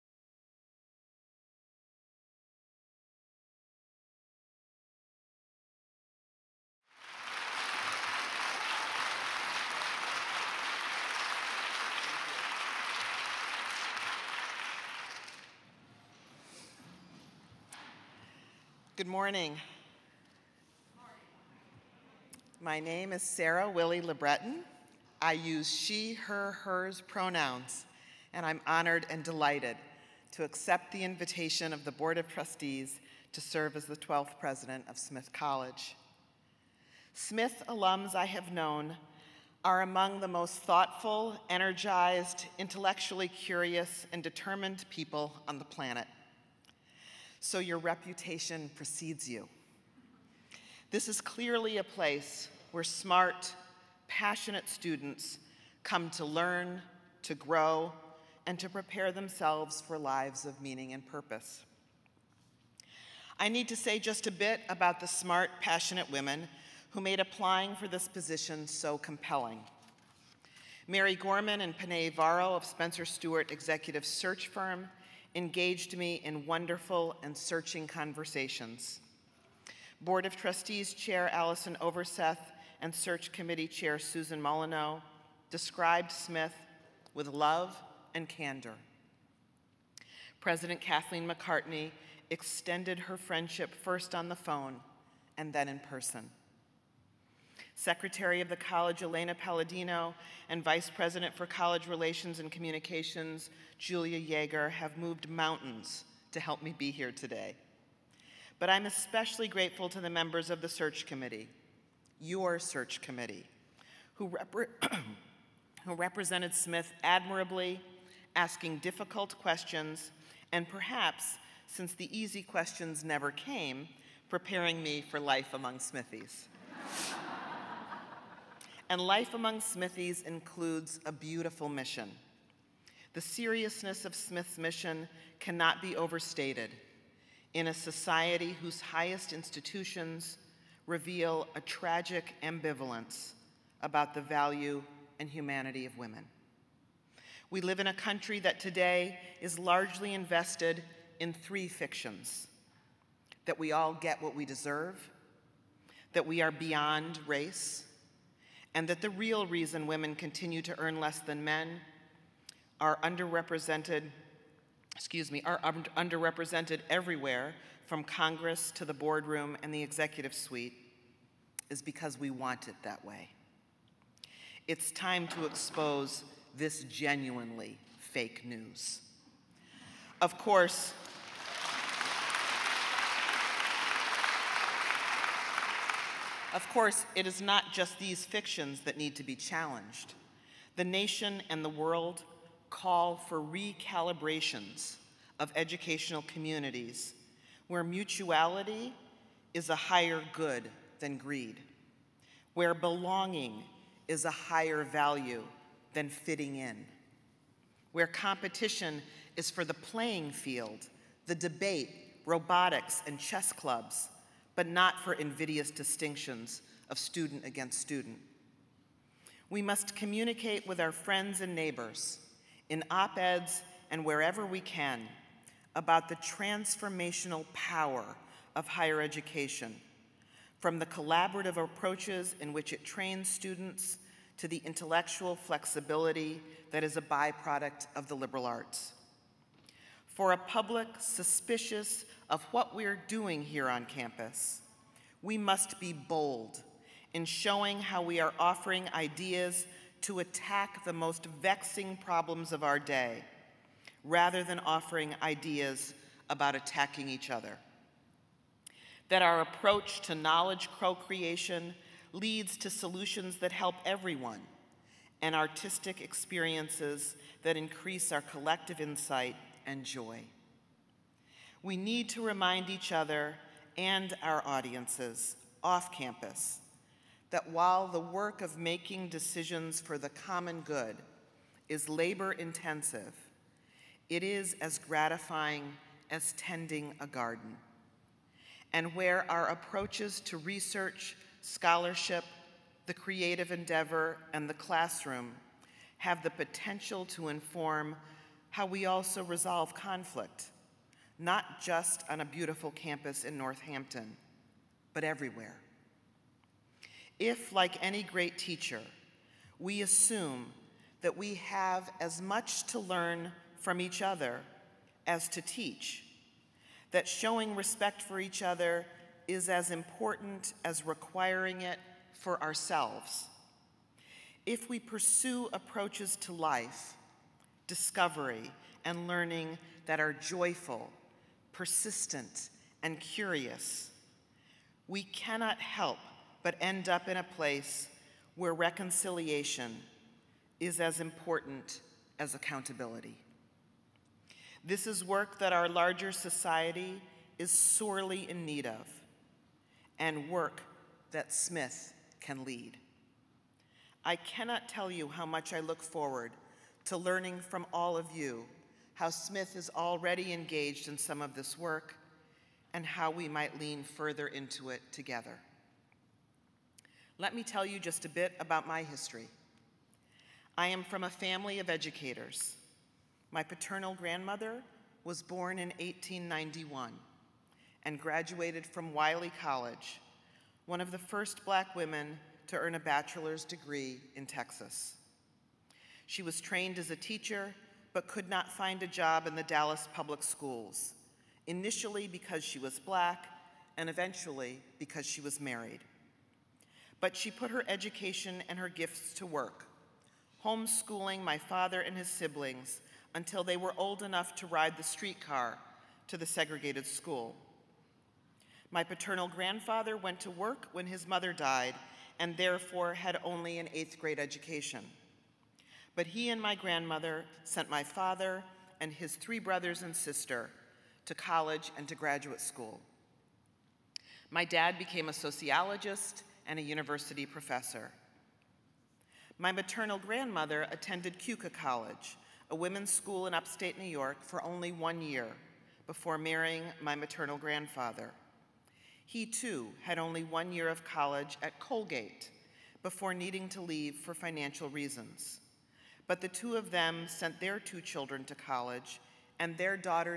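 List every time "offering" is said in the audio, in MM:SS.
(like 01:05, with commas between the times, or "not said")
04:08, 04:14.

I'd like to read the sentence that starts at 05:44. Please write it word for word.
This is work that our larger society is sorely in need of, and work that Smith can lead.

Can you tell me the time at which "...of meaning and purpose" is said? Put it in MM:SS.
01:00.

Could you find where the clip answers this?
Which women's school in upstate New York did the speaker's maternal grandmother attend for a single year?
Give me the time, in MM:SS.
07:11.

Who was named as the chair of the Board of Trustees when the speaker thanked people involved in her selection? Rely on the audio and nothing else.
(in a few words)
Allison Overseth.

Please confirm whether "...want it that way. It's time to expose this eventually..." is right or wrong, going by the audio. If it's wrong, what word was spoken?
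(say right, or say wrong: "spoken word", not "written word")
wrong: "genuinely", not "eventually".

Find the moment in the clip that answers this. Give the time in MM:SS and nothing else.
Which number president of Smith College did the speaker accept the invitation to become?
00:33.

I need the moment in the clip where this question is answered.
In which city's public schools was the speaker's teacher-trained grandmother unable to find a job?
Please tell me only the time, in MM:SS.
06:29.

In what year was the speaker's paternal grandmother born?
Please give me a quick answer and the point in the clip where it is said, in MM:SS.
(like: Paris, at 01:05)
1891, at 06:15.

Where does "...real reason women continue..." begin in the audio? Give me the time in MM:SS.
02:39.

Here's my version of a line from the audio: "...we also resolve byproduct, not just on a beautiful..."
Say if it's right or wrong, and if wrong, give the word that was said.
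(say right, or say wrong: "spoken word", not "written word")
wrong: "conflict", not "byproduct".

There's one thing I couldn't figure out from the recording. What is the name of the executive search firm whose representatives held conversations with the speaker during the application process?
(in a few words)
Spencer Stuart.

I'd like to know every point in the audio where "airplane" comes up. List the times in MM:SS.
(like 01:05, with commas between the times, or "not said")
not said.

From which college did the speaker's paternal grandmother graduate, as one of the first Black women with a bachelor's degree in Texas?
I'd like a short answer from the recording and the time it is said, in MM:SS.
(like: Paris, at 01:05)
Wiley College, at 06:18.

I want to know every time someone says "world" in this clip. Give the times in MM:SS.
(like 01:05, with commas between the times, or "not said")
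03:11.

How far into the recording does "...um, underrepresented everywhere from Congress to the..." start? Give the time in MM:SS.
02:45.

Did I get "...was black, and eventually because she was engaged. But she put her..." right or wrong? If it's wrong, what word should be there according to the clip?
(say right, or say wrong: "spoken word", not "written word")
wrong: "married", not "engaged".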